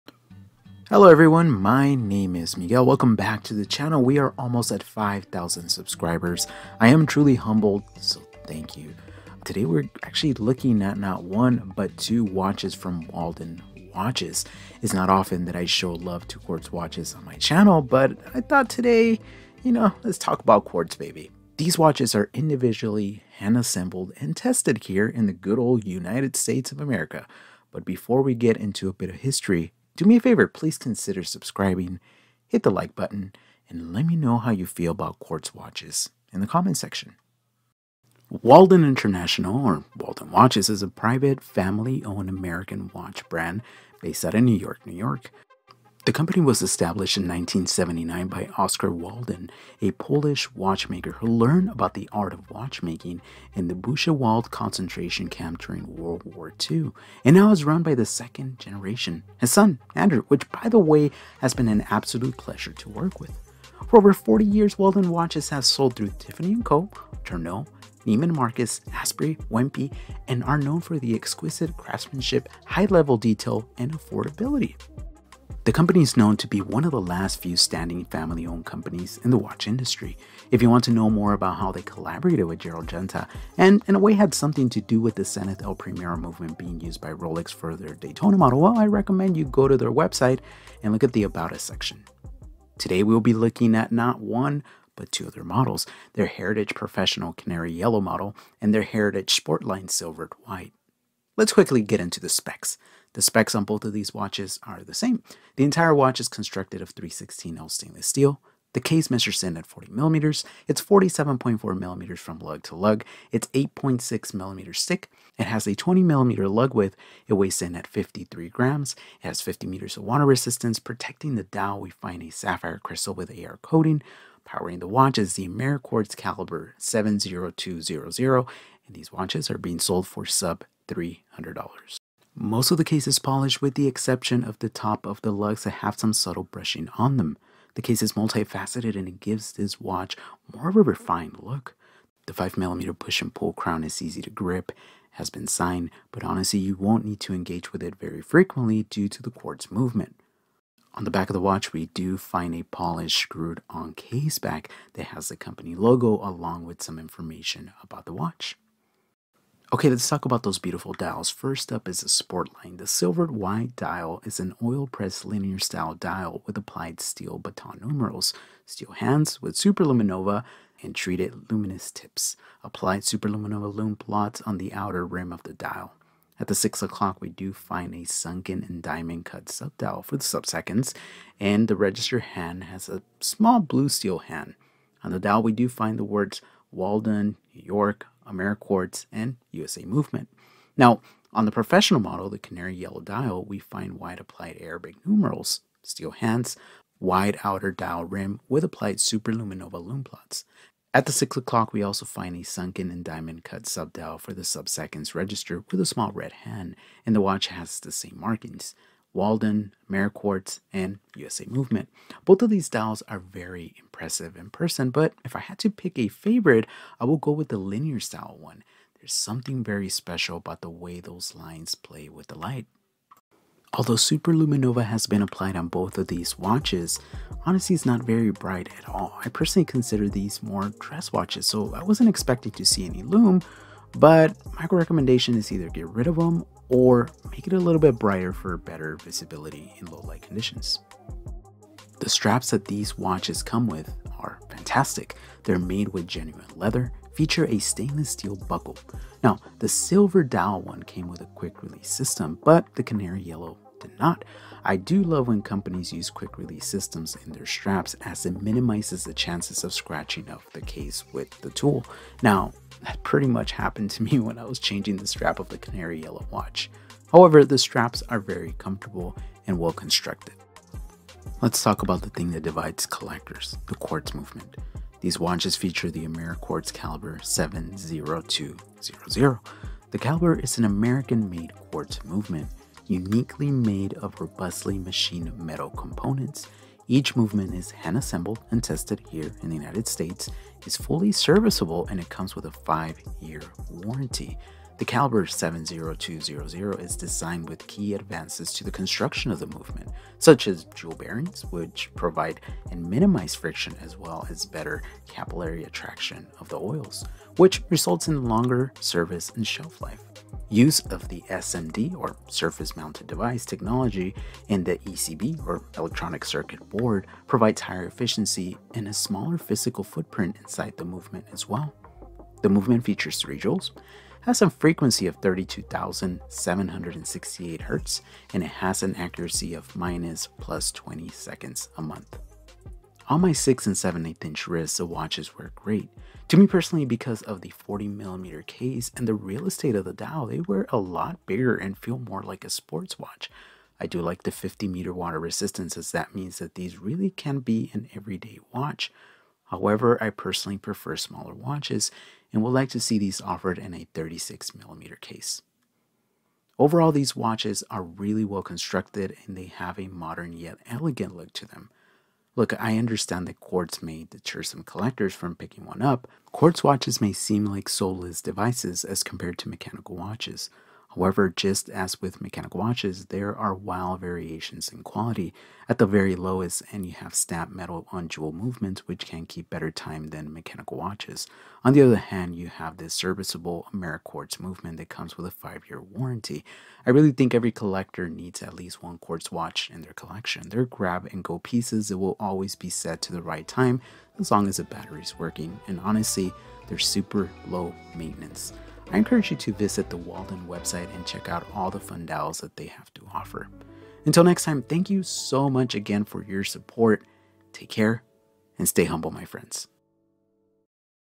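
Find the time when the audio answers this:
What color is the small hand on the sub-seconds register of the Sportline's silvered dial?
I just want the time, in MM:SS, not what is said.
03:03.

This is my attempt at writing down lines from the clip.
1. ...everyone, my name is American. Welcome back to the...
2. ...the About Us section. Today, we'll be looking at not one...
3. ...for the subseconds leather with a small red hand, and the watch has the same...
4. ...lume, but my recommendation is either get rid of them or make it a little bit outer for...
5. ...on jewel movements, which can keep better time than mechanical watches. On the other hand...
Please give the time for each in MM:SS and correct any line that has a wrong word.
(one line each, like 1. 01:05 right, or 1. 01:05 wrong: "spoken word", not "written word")
1. 00:01 wrong: "Miguel", not "American"
2. 01:31 right
3. 03:24 wrong: "register", not "leather"
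4. 03:53 wrong: "brighter", not "outer"
5. 06:17 right.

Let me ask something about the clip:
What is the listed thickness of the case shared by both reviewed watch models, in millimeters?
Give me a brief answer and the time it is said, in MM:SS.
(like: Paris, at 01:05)
8.6 millimeters, at 01:53.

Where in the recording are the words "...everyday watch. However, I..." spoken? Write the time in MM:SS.
05:47.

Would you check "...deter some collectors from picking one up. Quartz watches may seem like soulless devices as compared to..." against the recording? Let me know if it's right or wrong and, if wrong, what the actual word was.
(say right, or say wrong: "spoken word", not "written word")
right.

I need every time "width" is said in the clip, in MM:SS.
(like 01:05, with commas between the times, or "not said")
01:56.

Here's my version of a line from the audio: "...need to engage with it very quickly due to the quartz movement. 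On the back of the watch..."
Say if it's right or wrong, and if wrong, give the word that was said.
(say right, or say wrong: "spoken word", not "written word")
wrong: "frequently", not "quickly".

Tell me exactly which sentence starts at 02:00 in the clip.
Protecting the dial, we find a sapphire crystal with AR coating.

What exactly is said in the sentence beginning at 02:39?
Okay, let's talk about those beautiful dials.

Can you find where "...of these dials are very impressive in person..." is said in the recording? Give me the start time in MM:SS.
03:32.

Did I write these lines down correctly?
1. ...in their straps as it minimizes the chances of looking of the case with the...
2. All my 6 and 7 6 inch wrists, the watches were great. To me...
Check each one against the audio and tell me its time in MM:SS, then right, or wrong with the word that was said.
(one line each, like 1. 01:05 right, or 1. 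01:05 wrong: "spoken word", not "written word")
1. 04:17 wrong: "scratching", not "looking"
2. 05:33 wrong: "8", not "6".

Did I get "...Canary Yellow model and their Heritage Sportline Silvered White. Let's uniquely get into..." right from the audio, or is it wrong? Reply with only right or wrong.
wrong.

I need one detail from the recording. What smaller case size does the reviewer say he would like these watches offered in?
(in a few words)
36 millimeters.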